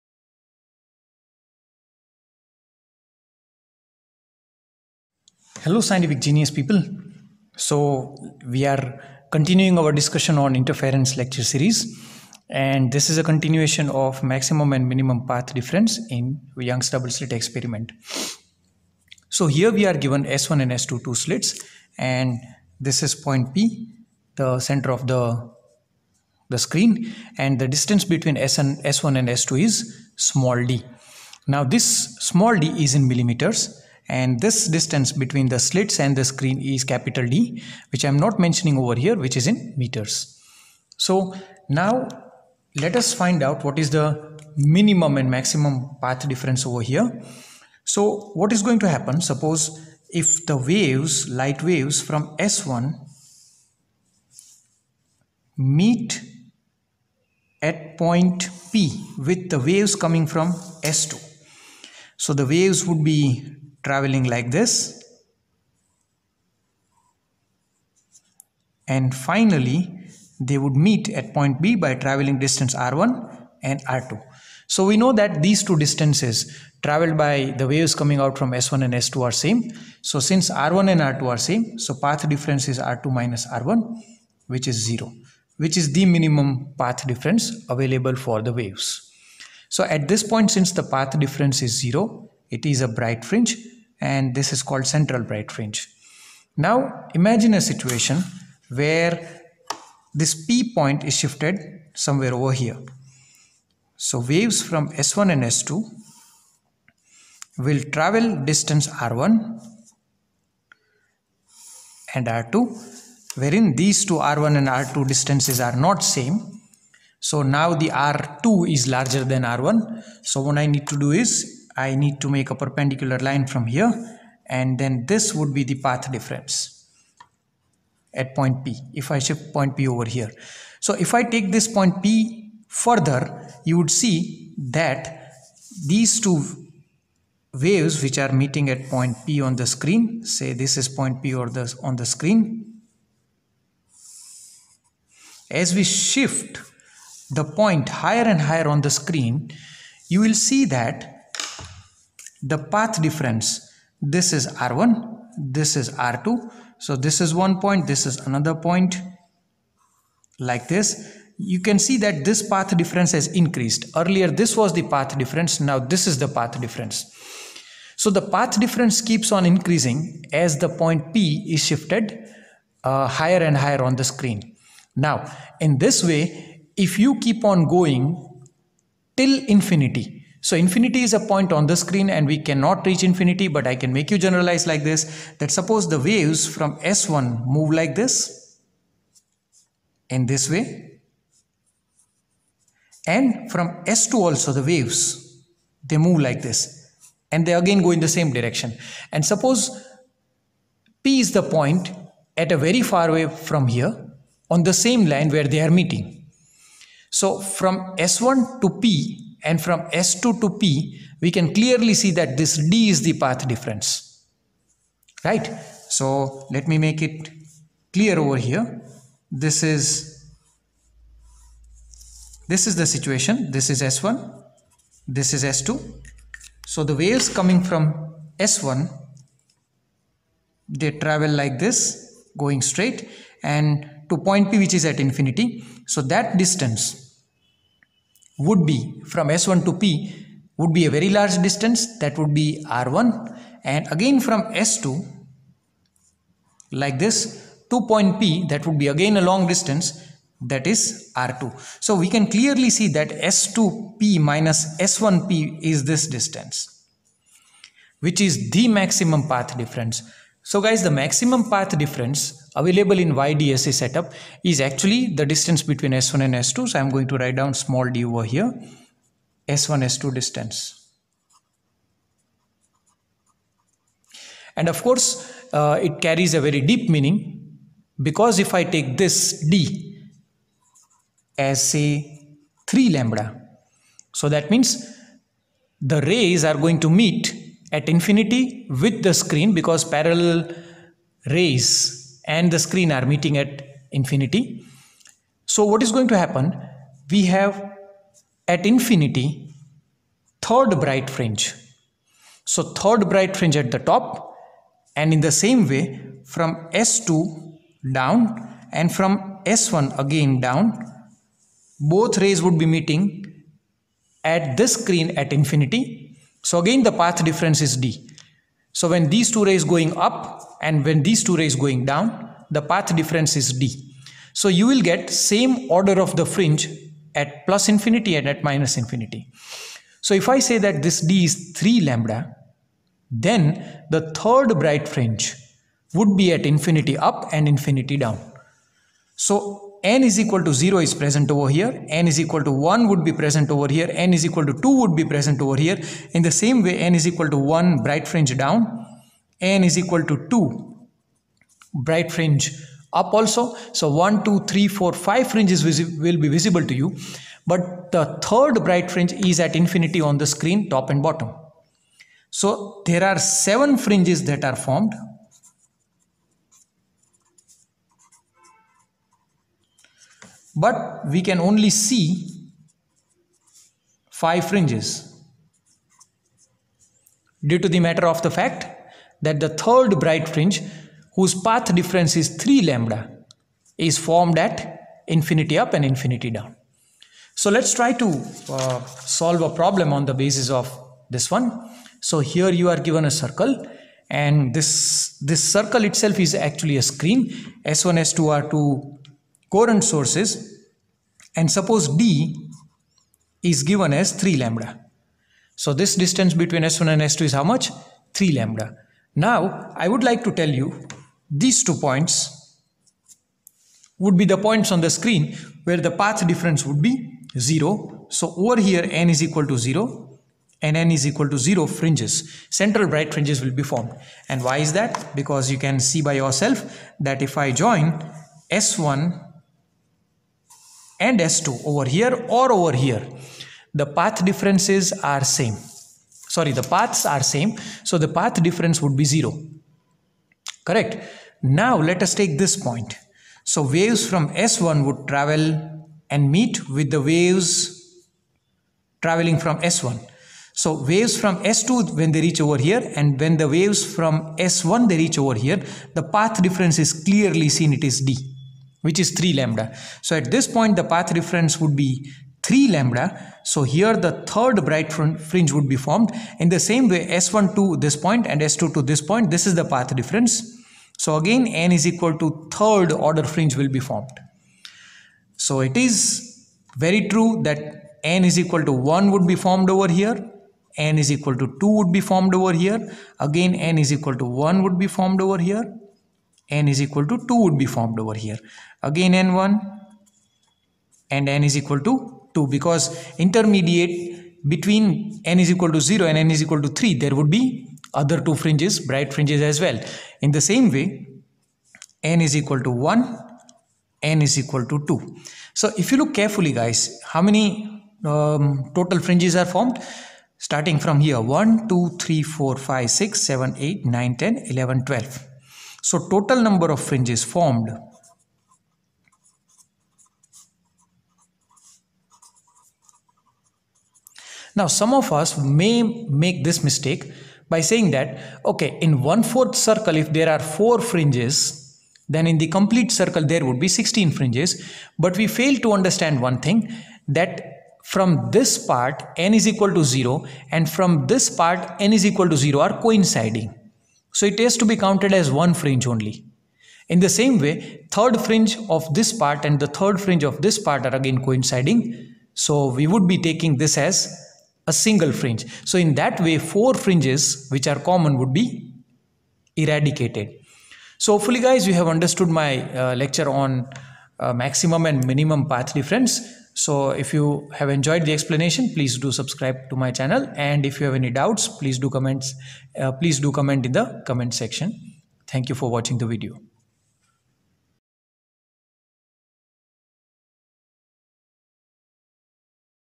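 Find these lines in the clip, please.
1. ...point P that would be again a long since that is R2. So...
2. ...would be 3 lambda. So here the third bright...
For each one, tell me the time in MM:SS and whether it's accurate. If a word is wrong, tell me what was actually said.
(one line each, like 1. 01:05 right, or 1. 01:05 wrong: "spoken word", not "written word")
1. 04:07 wrong: "distance", not "since"
2. 07:41 right.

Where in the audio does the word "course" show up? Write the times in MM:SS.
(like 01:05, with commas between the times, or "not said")
04:34.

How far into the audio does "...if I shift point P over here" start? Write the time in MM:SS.
02:08.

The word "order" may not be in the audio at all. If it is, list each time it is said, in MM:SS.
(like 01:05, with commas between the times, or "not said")
05:25, 07:52.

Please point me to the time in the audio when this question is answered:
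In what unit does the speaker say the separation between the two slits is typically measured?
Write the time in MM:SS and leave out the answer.
00:33.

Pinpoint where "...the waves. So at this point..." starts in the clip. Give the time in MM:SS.
01:28.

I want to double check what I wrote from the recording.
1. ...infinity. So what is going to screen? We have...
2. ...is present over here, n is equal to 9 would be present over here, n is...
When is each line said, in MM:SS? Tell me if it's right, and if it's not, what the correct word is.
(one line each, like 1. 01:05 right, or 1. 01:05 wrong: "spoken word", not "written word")
1. 04:53 wrong: "happen", not "screen"
2. 05:40 wrong: "1", not "9".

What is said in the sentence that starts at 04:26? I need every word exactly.
So I'm going to write down small d over here, S1, S2 distance.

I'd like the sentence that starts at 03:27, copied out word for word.
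So from S1 to P and from S2 to P, we can clearly see that this D is the path difference.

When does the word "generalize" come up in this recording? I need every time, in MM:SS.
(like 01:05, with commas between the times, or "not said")
03:04.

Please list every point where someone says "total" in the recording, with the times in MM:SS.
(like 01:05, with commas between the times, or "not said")
08:28, 08:36.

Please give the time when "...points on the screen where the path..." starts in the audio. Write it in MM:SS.
06:54.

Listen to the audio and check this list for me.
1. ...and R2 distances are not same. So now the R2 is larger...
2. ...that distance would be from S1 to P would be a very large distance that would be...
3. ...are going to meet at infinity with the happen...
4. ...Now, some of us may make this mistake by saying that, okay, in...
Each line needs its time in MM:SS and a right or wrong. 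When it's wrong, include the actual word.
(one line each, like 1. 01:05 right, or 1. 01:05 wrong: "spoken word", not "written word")
1. 01:54 right
2. 03:56 right
3. 04:46 wrong: "screen", not "happen"
4. 08:44 right.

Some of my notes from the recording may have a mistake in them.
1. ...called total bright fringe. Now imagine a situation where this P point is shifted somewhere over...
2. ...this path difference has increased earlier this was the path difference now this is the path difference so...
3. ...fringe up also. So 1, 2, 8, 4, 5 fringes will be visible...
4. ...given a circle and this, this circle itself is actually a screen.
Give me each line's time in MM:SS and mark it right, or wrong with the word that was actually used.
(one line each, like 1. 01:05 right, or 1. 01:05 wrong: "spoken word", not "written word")
1. 01:34 wrong: "central", not "total"
2. 02:42 right
3. 05:52 wrong: "3", not "8"
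4. 06:32 right.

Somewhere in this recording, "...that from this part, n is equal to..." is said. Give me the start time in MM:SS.
08:57.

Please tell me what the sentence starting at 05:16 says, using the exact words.
So again the path difference is D.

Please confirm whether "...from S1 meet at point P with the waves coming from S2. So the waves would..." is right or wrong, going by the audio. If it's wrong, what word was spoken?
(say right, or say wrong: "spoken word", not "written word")
right.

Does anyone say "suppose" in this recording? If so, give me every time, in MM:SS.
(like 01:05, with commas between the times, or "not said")
00:49, 03:05, 03:19, 06:41.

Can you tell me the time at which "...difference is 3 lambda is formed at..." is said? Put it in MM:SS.
06:21.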